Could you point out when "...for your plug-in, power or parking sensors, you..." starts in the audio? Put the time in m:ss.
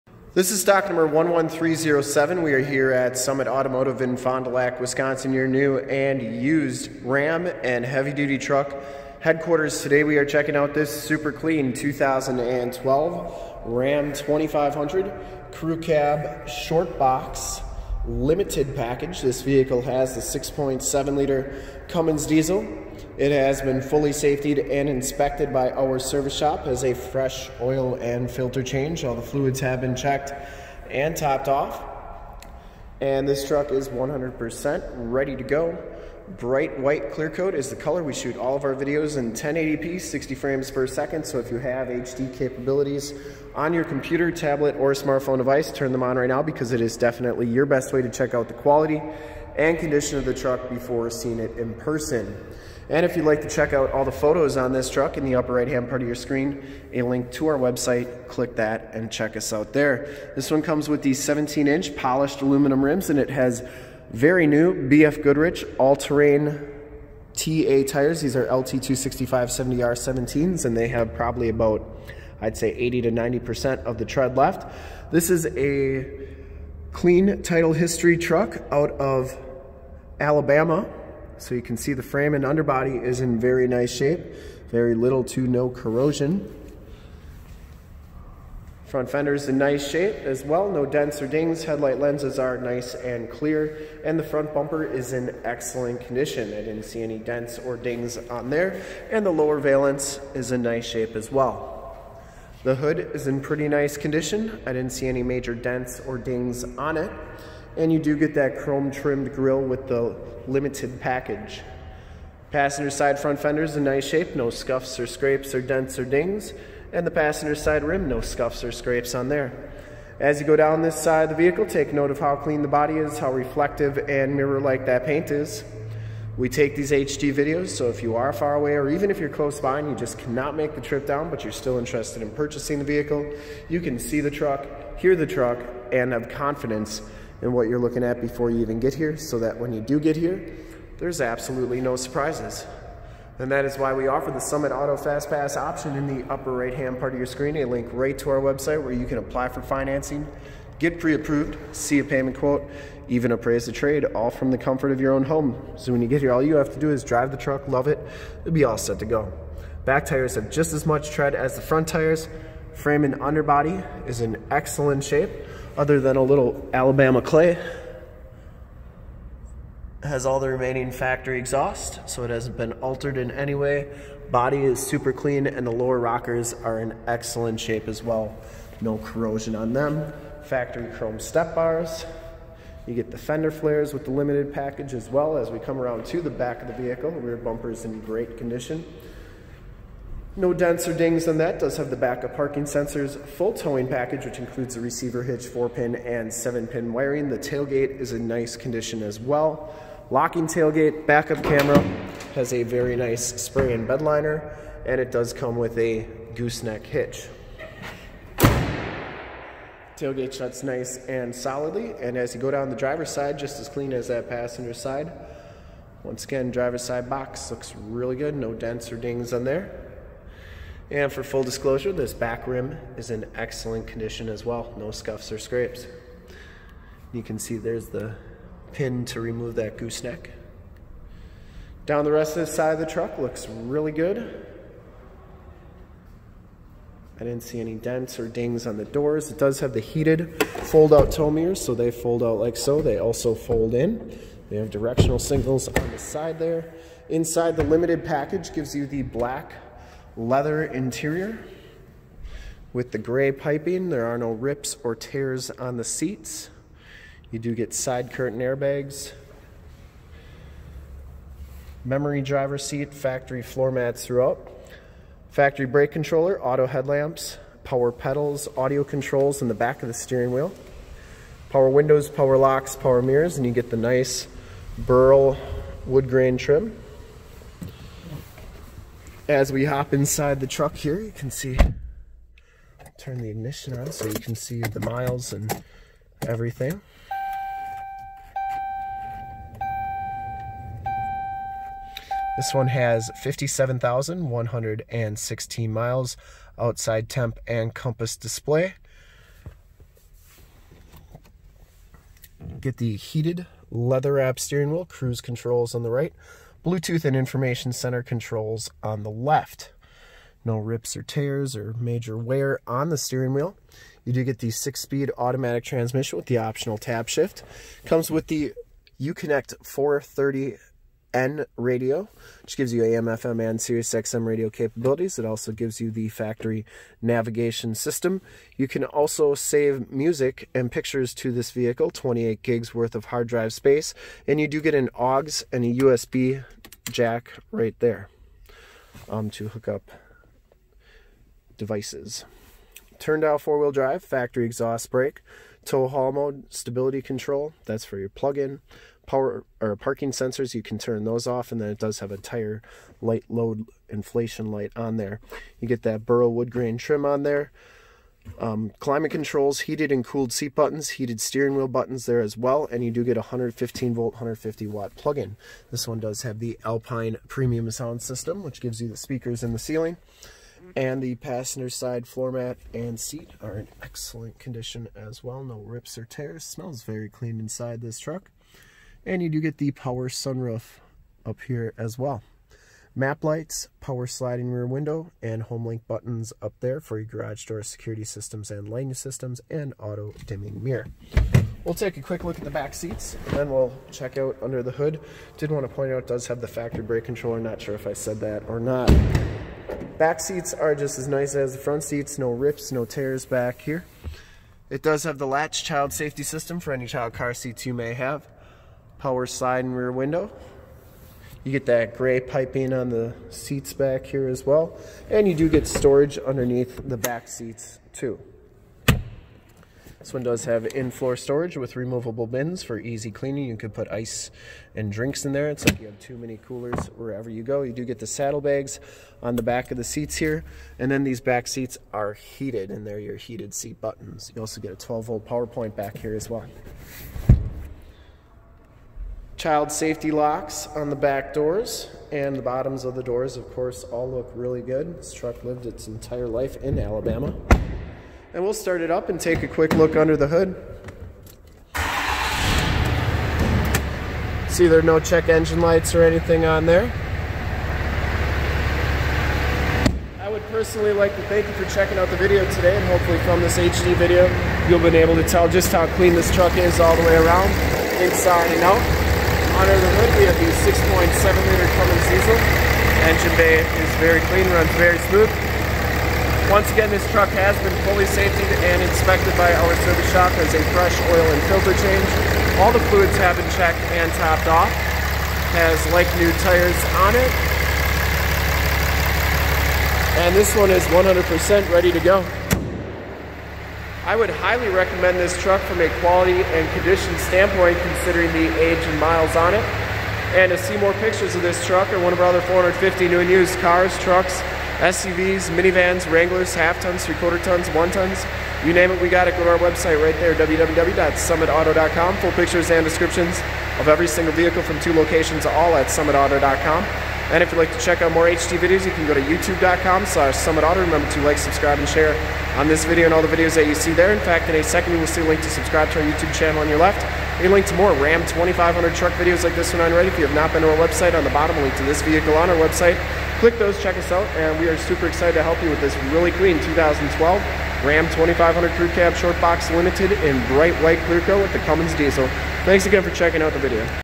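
5:47.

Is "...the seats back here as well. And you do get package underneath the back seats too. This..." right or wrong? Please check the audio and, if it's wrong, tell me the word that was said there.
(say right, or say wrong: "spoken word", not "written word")
wrong: "storage", not "package".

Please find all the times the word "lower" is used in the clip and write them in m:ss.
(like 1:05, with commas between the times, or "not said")
1:39, 2:55.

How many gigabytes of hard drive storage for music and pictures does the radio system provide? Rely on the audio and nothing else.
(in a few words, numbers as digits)
28.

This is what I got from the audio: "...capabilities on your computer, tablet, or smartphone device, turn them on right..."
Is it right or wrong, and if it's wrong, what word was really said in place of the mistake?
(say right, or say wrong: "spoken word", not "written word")
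right.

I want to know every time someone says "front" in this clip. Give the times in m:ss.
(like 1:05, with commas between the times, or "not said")
1:28, 1:34, 1:53, 2:41, 6:41.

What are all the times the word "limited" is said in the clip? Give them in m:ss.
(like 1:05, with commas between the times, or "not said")
0:18, 1:50, 3:04, 4:07, 8:59.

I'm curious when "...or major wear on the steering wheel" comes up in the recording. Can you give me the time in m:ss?
5:11.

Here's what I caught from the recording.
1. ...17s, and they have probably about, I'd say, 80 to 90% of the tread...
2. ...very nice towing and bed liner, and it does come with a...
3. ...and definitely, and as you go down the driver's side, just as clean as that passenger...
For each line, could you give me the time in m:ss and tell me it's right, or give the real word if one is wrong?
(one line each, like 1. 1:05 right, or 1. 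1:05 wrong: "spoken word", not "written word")
1. 1:09 right
2. 3:22 wrong: "spring", not "towing"
3. 3:31 wrong: "solidly", not "definitely".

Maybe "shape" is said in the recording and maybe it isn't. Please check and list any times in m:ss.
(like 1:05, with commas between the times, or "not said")
1:23, 1:29, 1:40, 1:54, 2:45, 2:57.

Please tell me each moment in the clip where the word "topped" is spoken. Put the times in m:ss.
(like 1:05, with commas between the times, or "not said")
0:31, 8:04.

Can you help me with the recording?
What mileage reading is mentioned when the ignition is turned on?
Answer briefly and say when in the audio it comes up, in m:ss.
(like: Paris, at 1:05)
57,116, at 4:53.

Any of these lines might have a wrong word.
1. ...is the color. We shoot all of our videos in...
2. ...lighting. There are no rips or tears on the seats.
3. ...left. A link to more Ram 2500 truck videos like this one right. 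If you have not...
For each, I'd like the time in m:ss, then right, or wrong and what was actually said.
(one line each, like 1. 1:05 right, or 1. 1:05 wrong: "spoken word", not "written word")
1. 0:37 right
2. 4:13 wrong: "piping", not "lighting"
3. 8:46 right.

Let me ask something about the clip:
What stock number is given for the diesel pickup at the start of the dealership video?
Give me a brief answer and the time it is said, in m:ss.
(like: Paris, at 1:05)
11307, at 0:01.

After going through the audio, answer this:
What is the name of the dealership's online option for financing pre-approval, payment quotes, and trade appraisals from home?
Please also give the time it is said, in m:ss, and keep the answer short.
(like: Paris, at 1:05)
Summit Auto Fast Pass, at 2:24.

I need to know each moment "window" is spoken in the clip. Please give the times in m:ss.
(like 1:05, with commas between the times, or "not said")
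4:31, 6:24, 6:49.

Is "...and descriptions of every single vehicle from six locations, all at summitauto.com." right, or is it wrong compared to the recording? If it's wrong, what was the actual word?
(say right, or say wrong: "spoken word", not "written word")
wrong: "two", not "six".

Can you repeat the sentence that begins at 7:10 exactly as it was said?
And then these back seats are heated and they're your heated seat buttons.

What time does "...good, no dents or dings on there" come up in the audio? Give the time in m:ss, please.
3:38.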